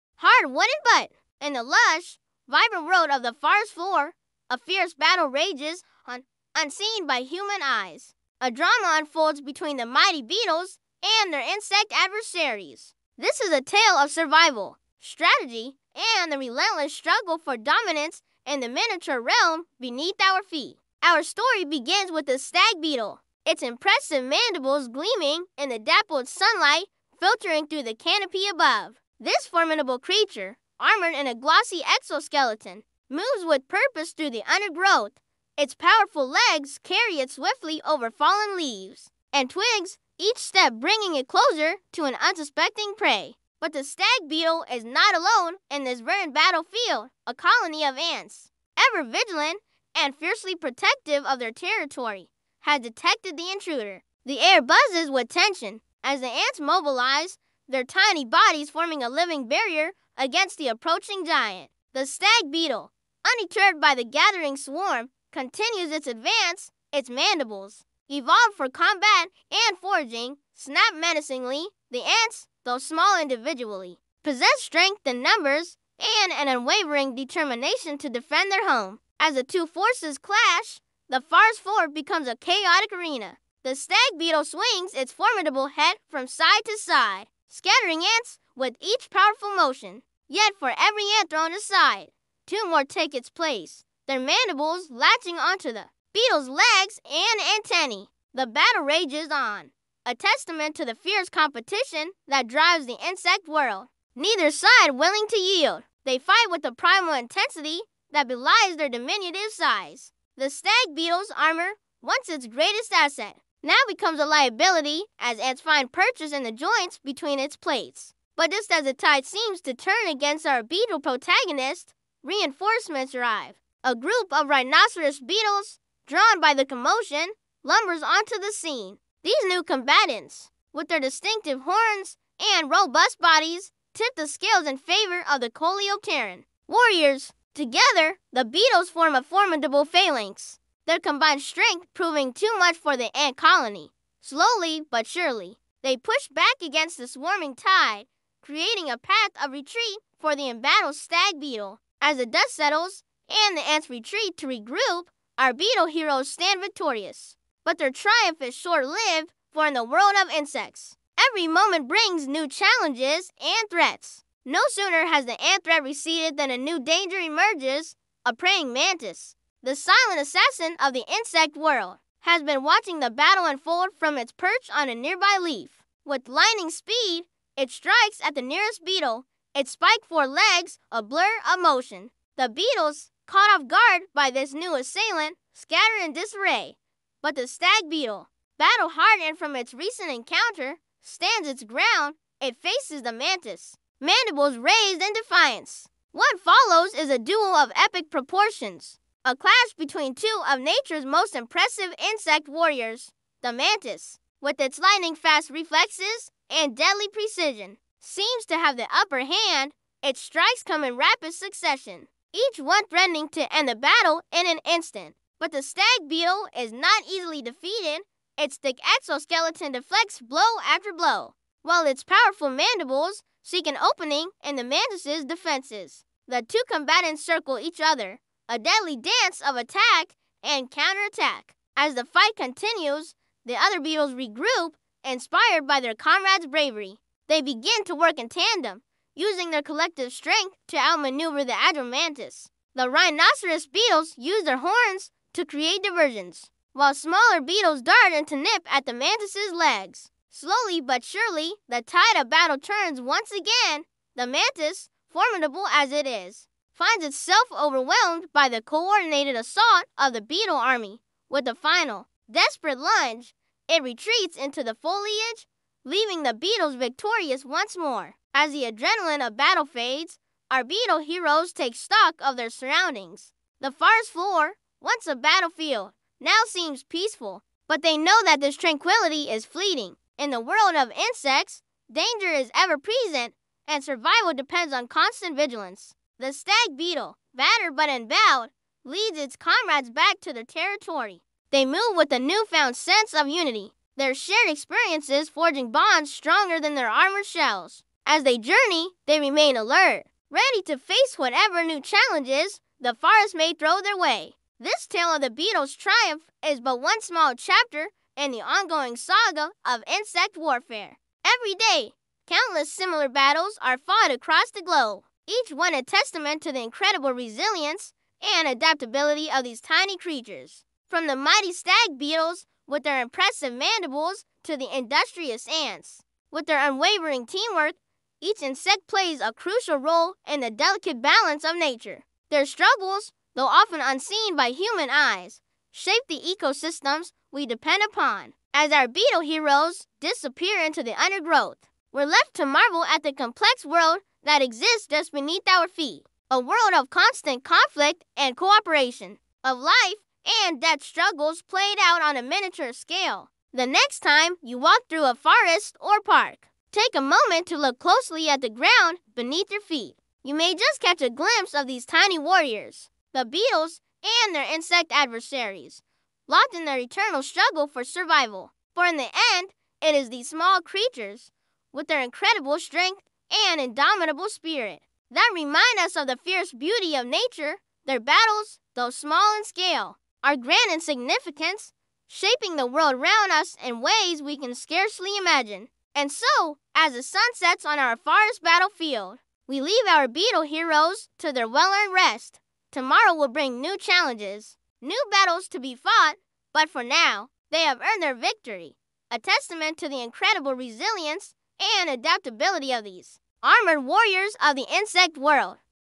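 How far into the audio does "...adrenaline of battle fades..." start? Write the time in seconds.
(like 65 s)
268 s.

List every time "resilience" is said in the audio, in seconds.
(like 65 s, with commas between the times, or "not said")
317 s, 400 s.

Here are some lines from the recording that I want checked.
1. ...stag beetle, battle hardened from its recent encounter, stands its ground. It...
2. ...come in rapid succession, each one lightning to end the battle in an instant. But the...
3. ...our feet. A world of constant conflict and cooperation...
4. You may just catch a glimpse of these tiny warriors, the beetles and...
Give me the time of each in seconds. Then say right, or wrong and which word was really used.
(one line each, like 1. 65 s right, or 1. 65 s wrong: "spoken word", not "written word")
1. 187 s right
2. 210 s wrong: "threatening", not "lightning"
3. 345 s right
4. 360 s right.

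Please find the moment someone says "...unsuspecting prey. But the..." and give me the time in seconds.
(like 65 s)
42 s.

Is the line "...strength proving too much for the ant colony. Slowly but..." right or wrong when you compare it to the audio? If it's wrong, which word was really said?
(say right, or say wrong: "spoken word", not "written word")
right.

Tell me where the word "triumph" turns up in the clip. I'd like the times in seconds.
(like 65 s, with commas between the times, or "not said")
157 s, 305 s.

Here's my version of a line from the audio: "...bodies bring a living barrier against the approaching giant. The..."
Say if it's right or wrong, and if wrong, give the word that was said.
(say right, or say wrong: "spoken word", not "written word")
wrong: "forming", not "bring".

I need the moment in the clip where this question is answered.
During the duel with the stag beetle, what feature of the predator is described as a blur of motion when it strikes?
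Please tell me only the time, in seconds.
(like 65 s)
179 s.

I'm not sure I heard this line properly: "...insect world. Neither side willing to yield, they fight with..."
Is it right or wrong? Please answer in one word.
right.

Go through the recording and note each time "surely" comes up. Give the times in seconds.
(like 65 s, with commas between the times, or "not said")
145 s, 251 s.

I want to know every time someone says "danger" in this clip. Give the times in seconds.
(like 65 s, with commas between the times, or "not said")
166 s, 281 s.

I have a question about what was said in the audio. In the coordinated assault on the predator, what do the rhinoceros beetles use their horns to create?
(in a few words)
Diversions.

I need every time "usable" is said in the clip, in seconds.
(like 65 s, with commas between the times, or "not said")
not said.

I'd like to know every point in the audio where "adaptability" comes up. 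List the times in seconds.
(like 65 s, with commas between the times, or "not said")
318 s, 401 s.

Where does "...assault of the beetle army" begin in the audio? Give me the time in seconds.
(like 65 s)
259 s.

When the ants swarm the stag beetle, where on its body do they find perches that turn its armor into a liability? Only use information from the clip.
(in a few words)
Joints between its plates.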